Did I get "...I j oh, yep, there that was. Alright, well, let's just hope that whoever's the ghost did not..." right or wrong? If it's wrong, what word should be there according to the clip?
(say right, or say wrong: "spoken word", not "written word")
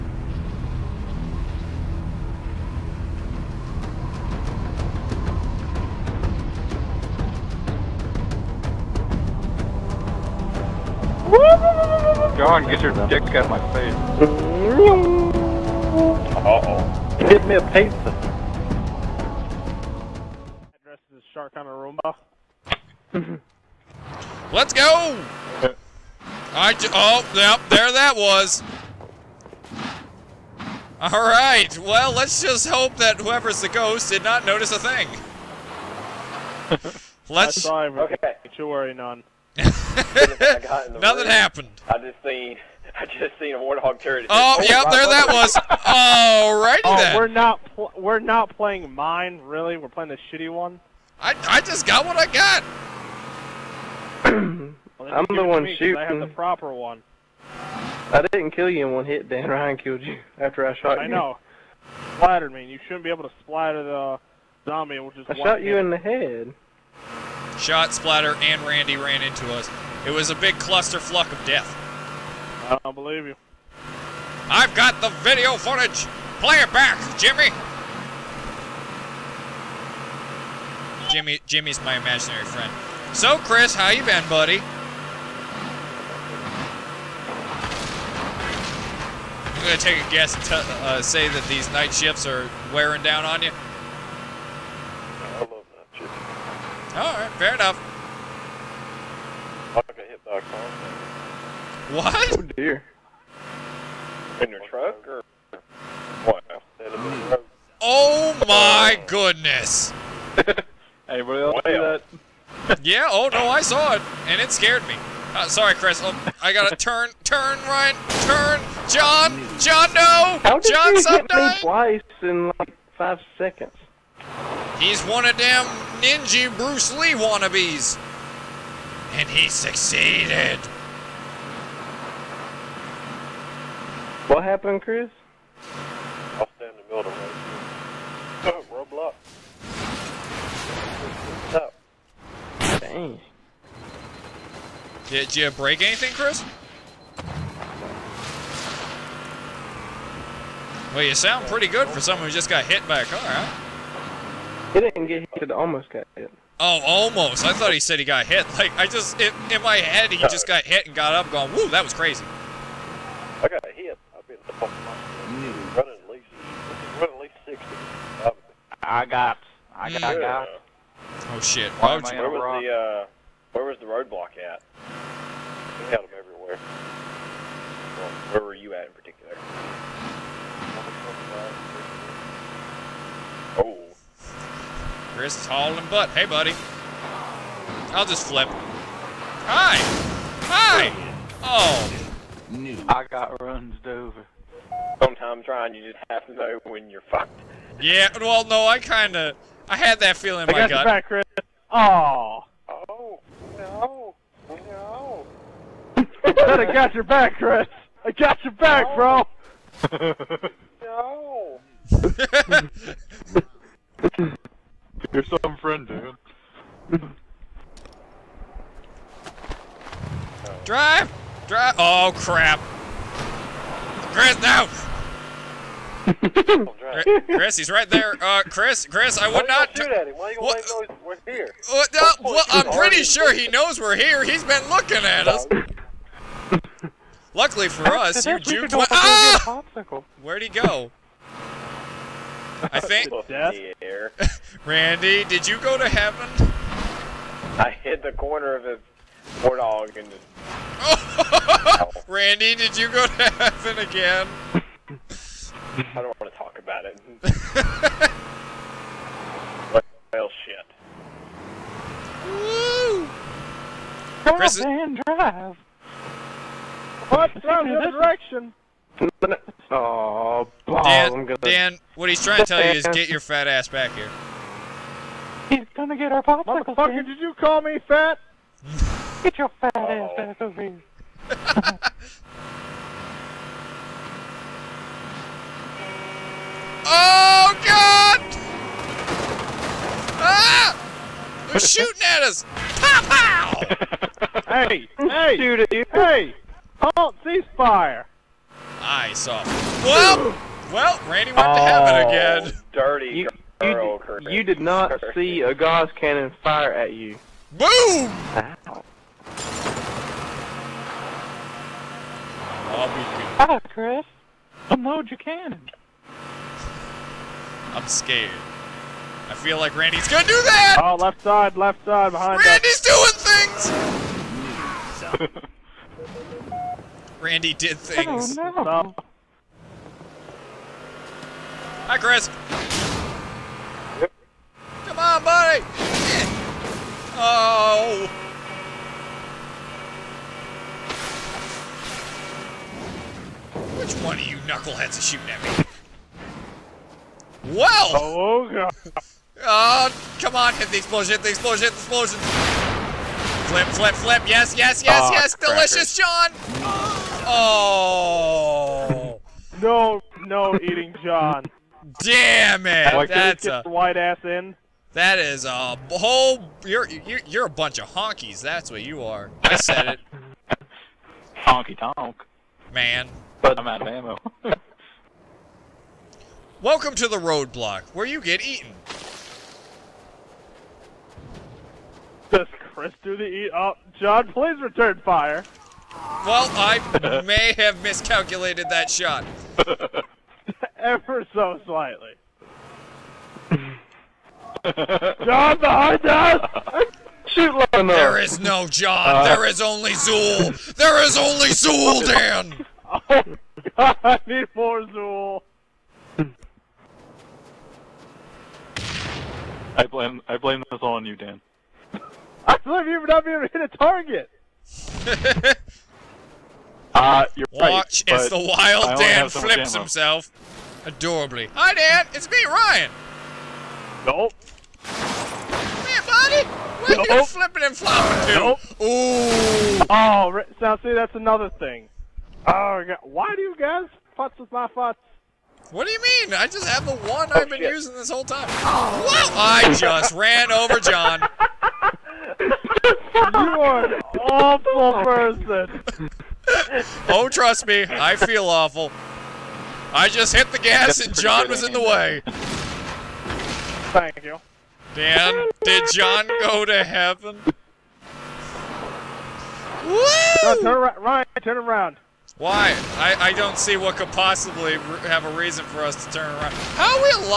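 right.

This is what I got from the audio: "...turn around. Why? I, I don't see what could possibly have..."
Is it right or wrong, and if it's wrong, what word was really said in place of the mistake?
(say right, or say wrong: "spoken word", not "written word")
right.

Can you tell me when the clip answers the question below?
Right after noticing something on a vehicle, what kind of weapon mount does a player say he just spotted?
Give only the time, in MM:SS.
00:43.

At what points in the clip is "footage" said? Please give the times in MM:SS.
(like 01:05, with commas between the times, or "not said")
01:15.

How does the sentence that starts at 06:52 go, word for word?
I blame you for not being able to hit a target.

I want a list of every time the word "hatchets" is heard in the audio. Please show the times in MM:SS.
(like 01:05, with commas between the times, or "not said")
not said.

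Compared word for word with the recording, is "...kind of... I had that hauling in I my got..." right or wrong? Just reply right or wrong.
wrong.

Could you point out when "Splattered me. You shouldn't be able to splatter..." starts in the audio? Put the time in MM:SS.
01:02.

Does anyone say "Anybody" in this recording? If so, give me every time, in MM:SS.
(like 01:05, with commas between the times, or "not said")
01:51.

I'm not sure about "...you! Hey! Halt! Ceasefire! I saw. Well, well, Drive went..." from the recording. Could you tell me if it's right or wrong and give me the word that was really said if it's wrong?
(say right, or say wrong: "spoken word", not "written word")
wrong: "Randy", not "Drive".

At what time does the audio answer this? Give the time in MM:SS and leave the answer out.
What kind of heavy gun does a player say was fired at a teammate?
05:05.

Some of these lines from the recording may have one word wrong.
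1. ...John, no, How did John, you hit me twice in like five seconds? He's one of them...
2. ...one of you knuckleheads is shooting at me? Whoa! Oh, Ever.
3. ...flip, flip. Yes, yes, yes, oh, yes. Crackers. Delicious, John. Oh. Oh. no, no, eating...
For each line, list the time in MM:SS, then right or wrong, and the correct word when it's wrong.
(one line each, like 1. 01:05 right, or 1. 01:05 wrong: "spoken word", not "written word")
1. 01:59 right
2. 05:44 wrong: "God", not "Ever"
3. 05:53 right.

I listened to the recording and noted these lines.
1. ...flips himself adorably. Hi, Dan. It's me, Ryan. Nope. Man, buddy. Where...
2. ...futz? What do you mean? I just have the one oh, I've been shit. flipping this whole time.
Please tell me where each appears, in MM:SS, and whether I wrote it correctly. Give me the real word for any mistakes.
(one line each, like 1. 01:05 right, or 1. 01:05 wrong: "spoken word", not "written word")
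1. 06:59 right
2. 07:14 wrong: "using", not "flipping".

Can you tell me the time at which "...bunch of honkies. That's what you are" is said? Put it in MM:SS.
06:07.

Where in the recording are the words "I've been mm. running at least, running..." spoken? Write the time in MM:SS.
02:44.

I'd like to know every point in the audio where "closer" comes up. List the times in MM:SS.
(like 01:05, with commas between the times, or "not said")
not said.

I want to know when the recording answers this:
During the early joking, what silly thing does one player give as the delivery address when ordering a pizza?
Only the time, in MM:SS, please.
00:21.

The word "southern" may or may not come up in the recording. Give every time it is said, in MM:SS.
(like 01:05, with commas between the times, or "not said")
not said.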